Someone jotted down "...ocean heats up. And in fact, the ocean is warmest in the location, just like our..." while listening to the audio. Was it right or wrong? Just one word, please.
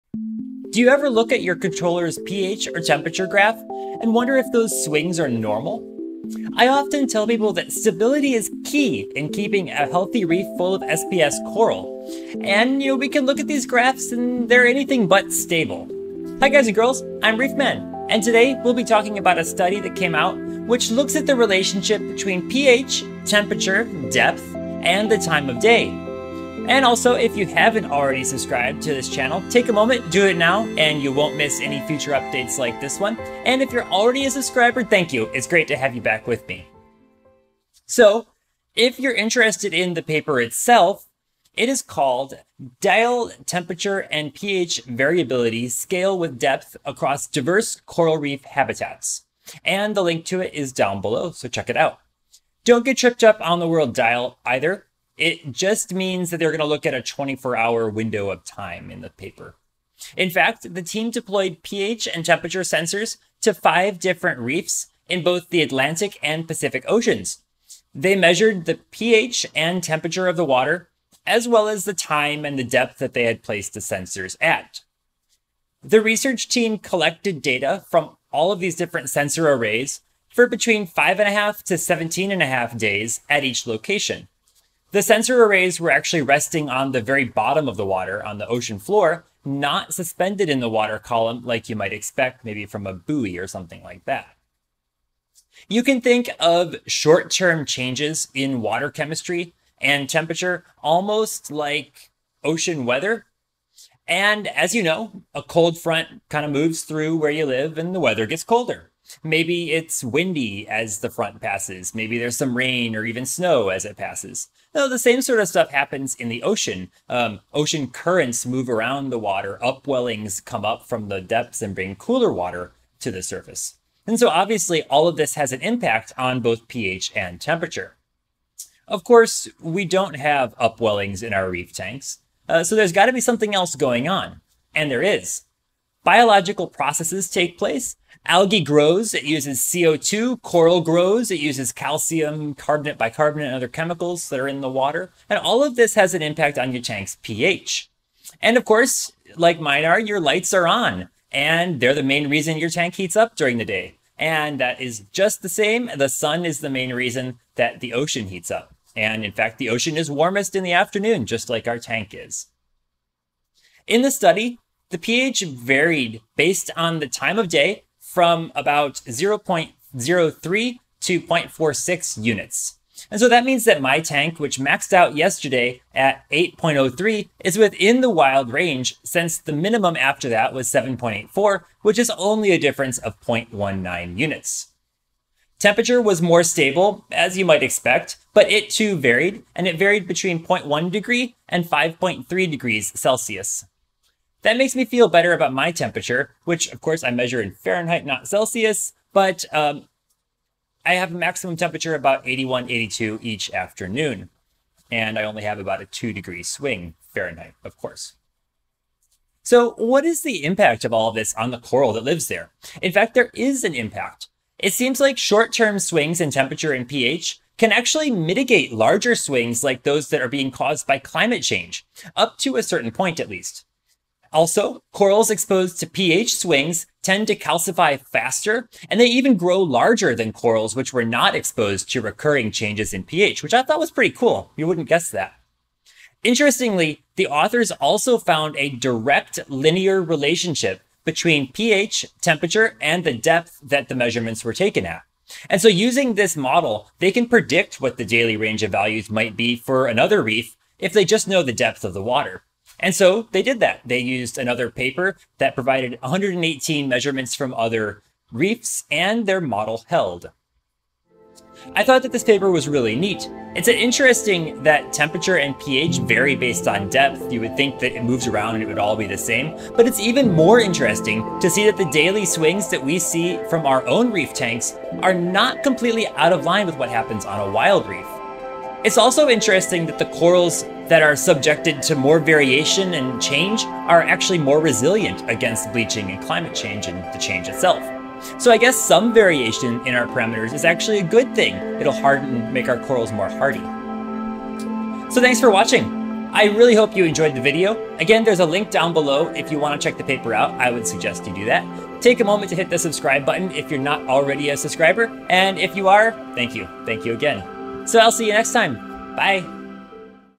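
wrong.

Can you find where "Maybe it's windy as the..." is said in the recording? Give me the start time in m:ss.
1:49.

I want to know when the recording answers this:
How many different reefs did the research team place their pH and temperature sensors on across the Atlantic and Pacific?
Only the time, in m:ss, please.
1:03.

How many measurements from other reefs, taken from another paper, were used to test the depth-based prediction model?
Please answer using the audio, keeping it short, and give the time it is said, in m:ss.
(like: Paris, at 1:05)
118, at 4:16.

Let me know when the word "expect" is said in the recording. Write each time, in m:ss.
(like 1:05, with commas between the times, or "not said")
1:31, 3:07.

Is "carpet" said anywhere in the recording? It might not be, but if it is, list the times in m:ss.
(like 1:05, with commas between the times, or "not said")
not said.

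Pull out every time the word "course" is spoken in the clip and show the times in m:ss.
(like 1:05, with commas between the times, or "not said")
2:09, 2:28, 3:16, 3:27.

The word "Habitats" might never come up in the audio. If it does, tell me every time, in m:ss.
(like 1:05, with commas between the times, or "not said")
0:48.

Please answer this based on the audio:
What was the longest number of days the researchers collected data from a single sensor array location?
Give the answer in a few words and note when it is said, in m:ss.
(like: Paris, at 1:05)
17.5 days, at 1:21.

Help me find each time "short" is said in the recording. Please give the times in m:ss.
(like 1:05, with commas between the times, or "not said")
1:36, 3:35.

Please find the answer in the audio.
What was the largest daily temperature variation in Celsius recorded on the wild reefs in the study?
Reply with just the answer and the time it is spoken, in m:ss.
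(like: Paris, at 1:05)
5.3 degrees Celsius, at 3:11.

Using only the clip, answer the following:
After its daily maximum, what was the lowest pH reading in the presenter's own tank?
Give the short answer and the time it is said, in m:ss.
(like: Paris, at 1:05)
7.84, at 3:00.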